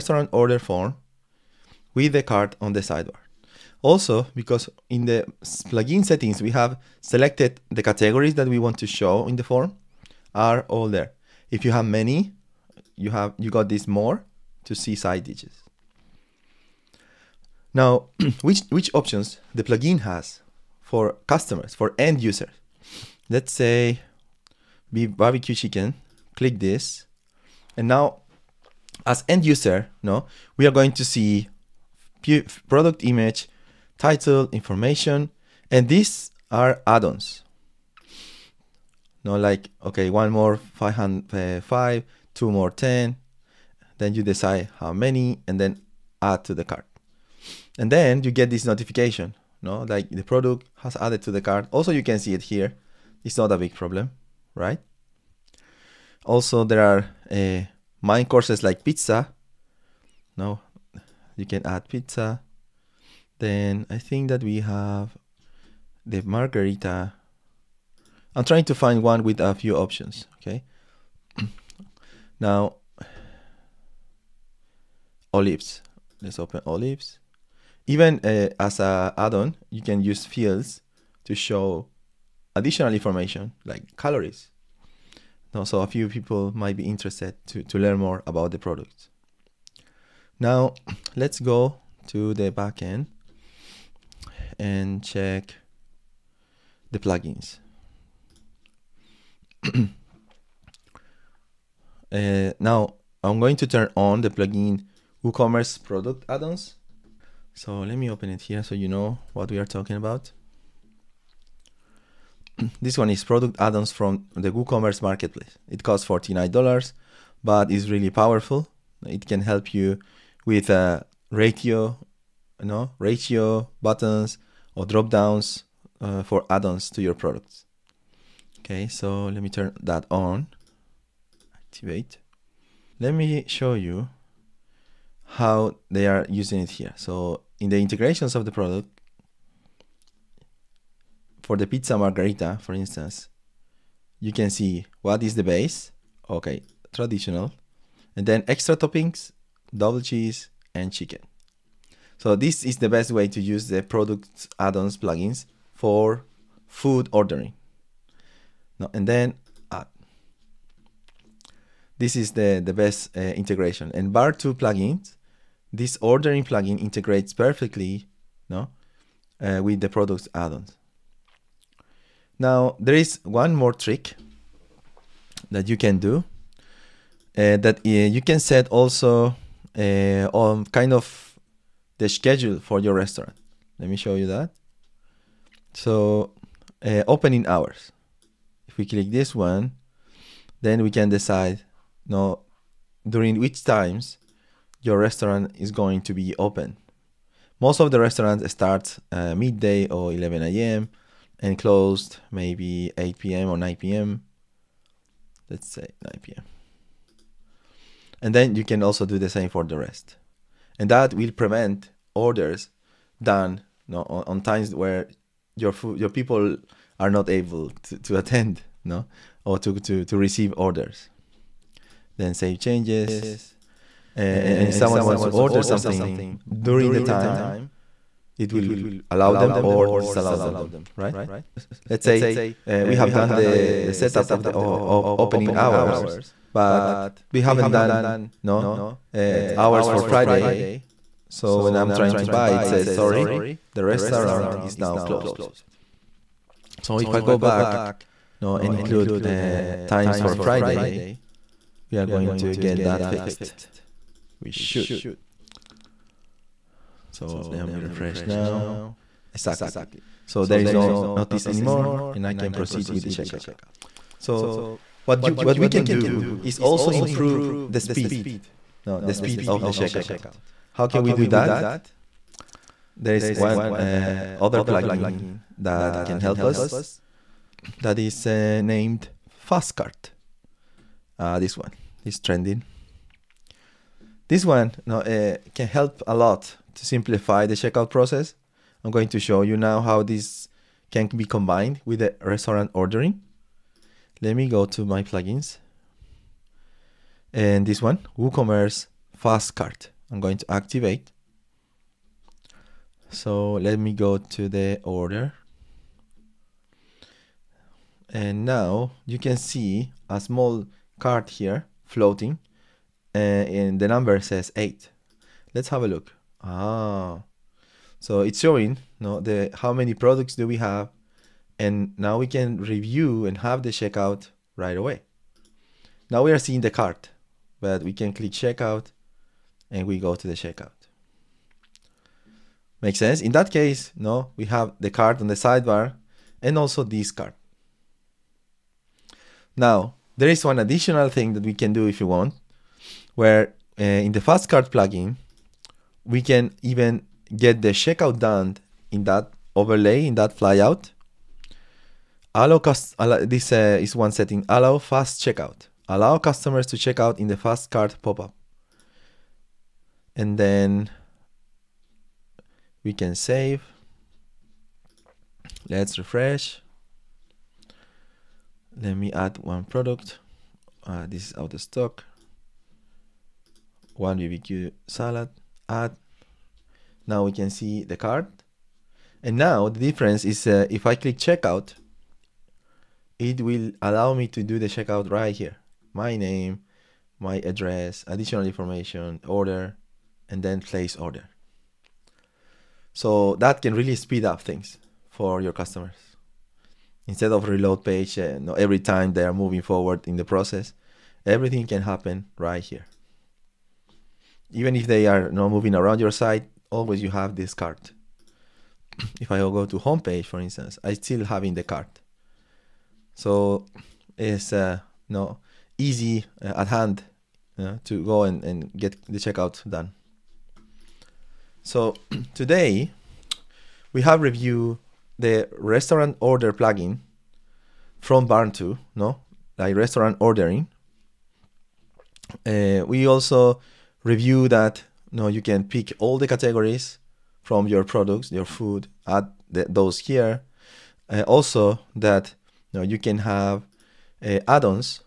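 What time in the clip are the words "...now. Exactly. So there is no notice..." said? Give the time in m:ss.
4:18.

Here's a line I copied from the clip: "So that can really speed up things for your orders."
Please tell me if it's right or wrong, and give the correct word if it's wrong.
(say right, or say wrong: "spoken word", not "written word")
wrong: "customers", not "orders".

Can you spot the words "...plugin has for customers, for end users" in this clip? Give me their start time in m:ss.
0:19.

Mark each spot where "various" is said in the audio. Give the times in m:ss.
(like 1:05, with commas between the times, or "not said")
not said.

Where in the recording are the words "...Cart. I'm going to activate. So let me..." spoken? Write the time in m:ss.
4:59.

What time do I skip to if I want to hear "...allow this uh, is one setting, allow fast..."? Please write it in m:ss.
5:52.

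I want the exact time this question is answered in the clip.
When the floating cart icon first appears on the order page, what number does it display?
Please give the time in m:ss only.
5:13.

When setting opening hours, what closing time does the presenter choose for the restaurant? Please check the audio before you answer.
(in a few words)
9 p.m.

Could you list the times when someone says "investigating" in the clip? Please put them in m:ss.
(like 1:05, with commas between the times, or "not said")
not said.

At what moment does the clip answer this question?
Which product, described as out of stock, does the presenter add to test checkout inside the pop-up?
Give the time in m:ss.
6:14.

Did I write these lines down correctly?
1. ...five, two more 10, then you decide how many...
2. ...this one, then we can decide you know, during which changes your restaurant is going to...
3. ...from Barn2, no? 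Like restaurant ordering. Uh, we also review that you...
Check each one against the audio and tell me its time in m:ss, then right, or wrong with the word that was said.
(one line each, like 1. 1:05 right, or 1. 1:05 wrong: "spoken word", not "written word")
1. 0:41 right
2. 3:09 wrong: "times", not "changes"
3. 7:08 right.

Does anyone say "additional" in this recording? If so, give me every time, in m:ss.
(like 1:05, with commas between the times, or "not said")
1:22, 5:40, 6:28.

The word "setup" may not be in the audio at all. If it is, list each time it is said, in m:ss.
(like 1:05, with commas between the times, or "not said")
3:53.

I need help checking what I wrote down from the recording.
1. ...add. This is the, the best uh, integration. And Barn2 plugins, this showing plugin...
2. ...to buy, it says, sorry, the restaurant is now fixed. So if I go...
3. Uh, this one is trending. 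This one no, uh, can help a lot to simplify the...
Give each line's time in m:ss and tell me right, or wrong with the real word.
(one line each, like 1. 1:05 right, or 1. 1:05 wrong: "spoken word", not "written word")
1. 2:39 wrong: "ordering", not "showing"
2. 4:02 wrong: "closed", not "fixed"
3. 4:41 right.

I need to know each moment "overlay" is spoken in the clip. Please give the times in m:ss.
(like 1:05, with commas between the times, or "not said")
5:49.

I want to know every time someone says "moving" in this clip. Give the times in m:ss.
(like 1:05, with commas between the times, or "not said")
6:39, 6:45.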